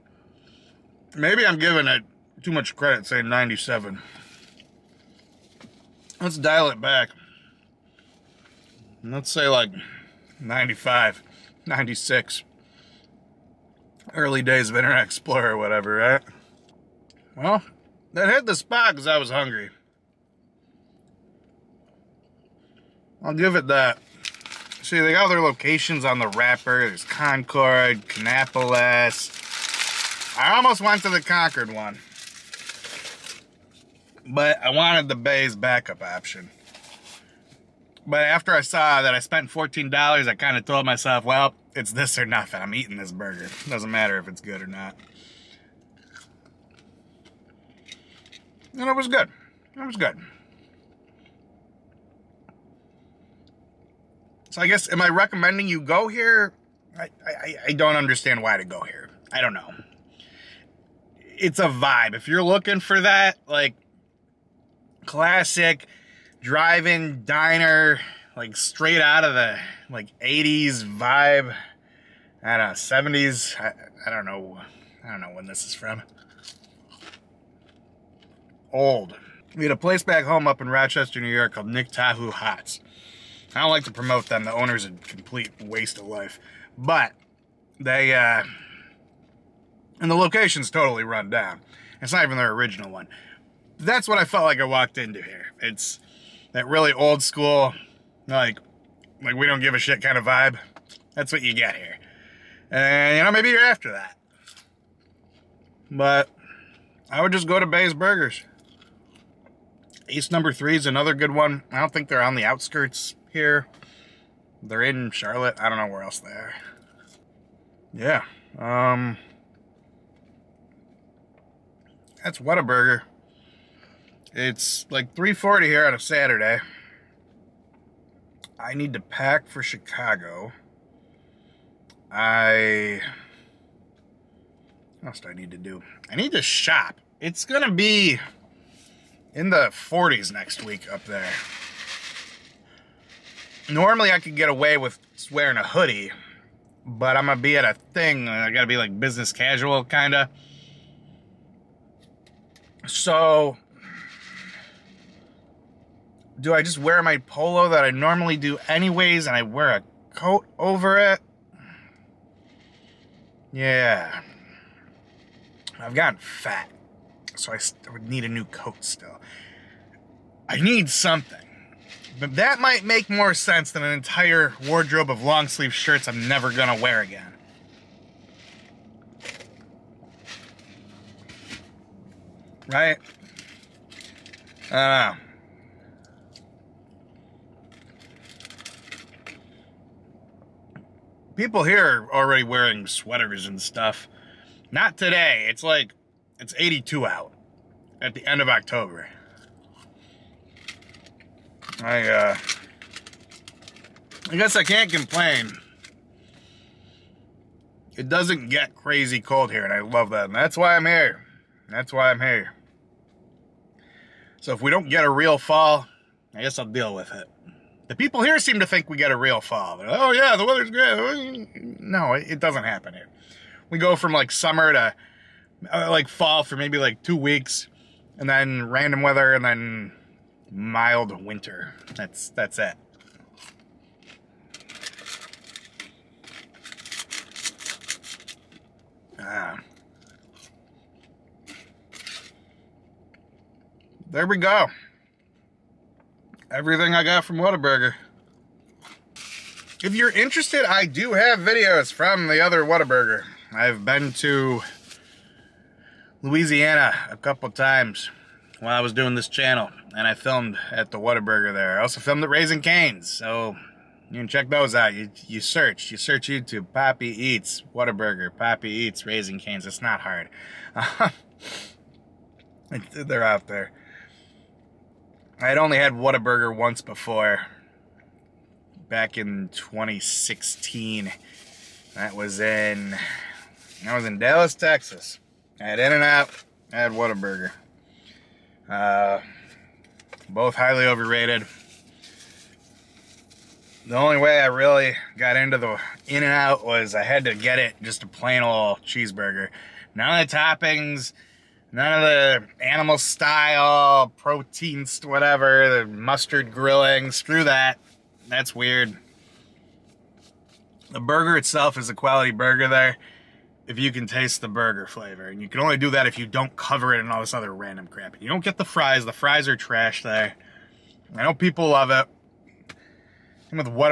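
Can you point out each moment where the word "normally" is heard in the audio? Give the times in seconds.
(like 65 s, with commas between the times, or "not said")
143 s, 157 s.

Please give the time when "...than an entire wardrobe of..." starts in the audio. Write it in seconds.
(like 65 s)
173 s.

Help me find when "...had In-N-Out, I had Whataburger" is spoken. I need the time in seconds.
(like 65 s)
285 s.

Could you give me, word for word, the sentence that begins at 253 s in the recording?
I've been to Louisiana a couple times.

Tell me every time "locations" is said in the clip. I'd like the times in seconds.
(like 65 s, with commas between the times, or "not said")
25 s, 90 s.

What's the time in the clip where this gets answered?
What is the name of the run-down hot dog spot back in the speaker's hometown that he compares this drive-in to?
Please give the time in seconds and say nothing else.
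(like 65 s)
81 s.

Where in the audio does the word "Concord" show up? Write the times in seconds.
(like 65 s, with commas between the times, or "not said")
27 s, 31 s.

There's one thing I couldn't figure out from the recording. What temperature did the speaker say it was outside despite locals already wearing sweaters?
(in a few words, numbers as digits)
82.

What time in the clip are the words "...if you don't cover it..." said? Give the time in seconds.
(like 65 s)
316 s.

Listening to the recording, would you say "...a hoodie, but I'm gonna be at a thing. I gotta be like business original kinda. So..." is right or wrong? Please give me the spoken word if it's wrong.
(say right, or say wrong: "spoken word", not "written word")
wrong: "casual", not "original".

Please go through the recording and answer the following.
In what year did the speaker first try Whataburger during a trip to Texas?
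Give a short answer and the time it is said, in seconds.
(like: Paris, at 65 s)
2016, at 279 s.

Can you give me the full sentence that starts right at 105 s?
But I would just go to Bay's Burgers.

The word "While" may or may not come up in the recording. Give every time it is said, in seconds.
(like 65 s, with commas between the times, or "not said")
258 s.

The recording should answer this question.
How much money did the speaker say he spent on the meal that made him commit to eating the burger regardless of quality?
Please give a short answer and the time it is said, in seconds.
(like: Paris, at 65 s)
$14, at 39 s.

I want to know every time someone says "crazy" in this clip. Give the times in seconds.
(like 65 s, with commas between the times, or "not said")
208 s.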